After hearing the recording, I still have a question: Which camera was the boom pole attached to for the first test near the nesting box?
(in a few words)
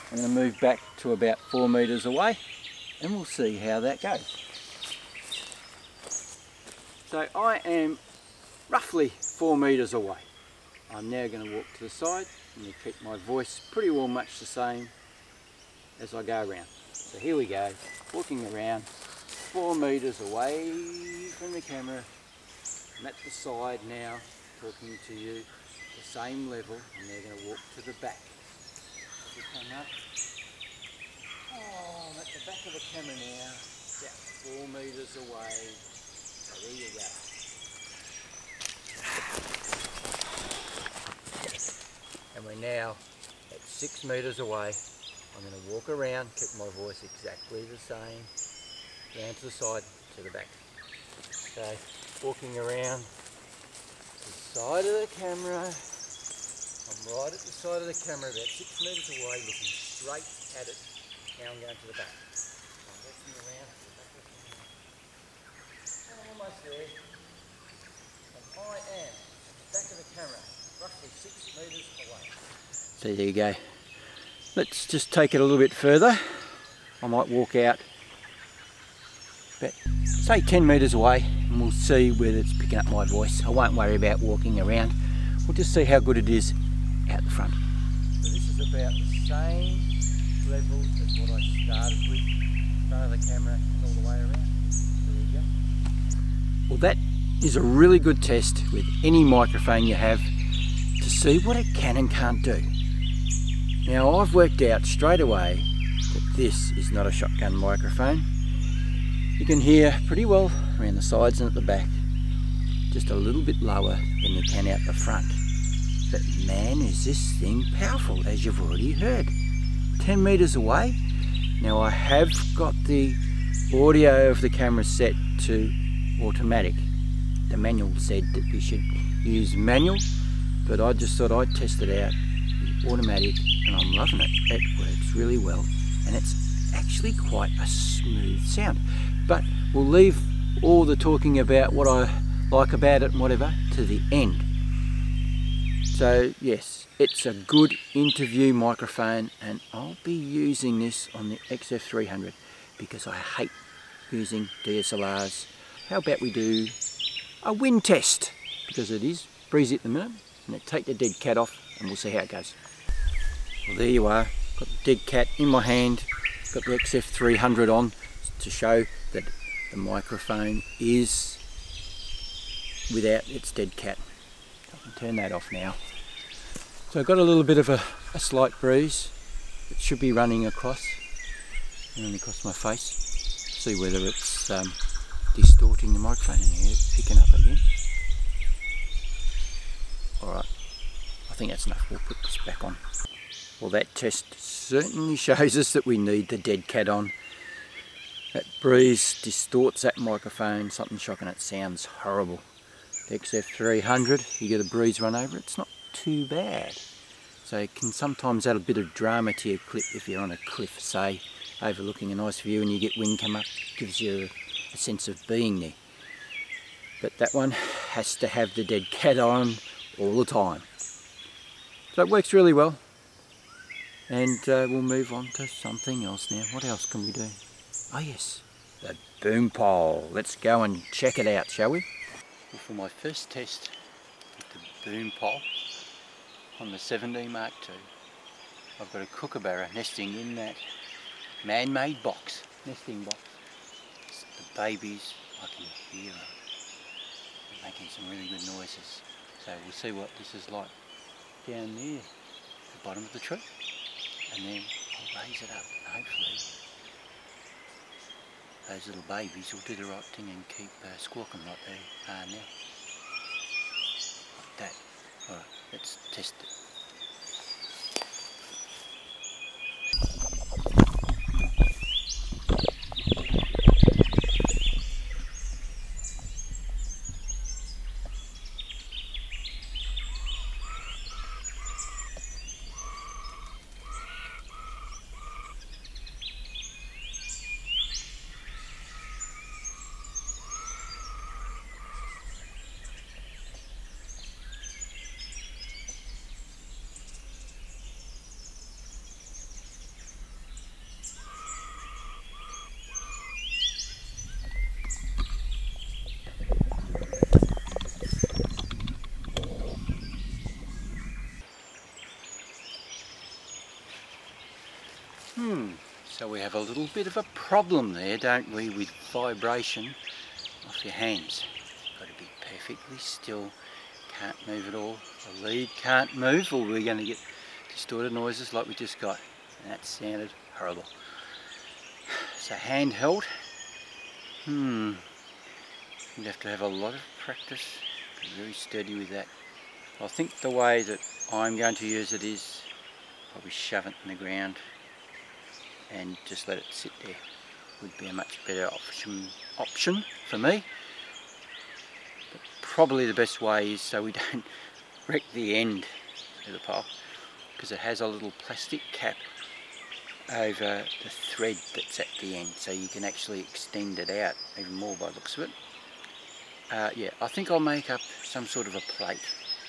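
7D Mark II.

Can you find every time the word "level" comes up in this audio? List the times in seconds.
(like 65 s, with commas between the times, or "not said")
26 s, 90 s.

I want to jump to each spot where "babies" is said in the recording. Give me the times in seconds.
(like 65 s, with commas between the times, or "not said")
244 s, 259 s.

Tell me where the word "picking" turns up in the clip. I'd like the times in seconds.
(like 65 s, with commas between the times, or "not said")
82 s, 186 s.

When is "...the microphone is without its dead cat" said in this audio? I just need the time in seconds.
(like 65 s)
169 s.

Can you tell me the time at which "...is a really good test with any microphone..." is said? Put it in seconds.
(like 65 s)
97 s.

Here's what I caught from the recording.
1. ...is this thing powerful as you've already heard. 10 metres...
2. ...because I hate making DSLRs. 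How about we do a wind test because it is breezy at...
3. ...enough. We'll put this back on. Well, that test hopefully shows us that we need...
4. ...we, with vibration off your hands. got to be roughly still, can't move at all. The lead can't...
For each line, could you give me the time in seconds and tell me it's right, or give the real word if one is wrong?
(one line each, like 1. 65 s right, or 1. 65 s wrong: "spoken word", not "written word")
1. 116 s right
2. 152 s wrong: "using", not "making"
3. 191 s wrong: "certainly", not "hopefully"
4. 318 s wrong: "perfectly", not "roughly".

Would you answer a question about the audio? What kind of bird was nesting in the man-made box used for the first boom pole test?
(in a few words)
Kookaburra.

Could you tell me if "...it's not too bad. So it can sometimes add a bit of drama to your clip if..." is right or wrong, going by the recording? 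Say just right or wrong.
right.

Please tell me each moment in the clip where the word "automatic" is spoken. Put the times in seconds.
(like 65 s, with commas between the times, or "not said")
126 s, 132 s.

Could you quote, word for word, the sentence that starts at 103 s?
Now I've worked out straight away that this is not a shotgun microphone.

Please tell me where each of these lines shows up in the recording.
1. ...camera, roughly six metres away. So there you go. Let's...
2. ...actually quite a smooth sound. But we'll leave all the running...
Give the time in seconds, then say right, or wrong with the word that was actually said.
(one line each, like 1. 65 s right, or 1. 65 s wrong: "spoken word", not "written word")
1. 70 s right
2. 136 s wrong: "talking", not "running".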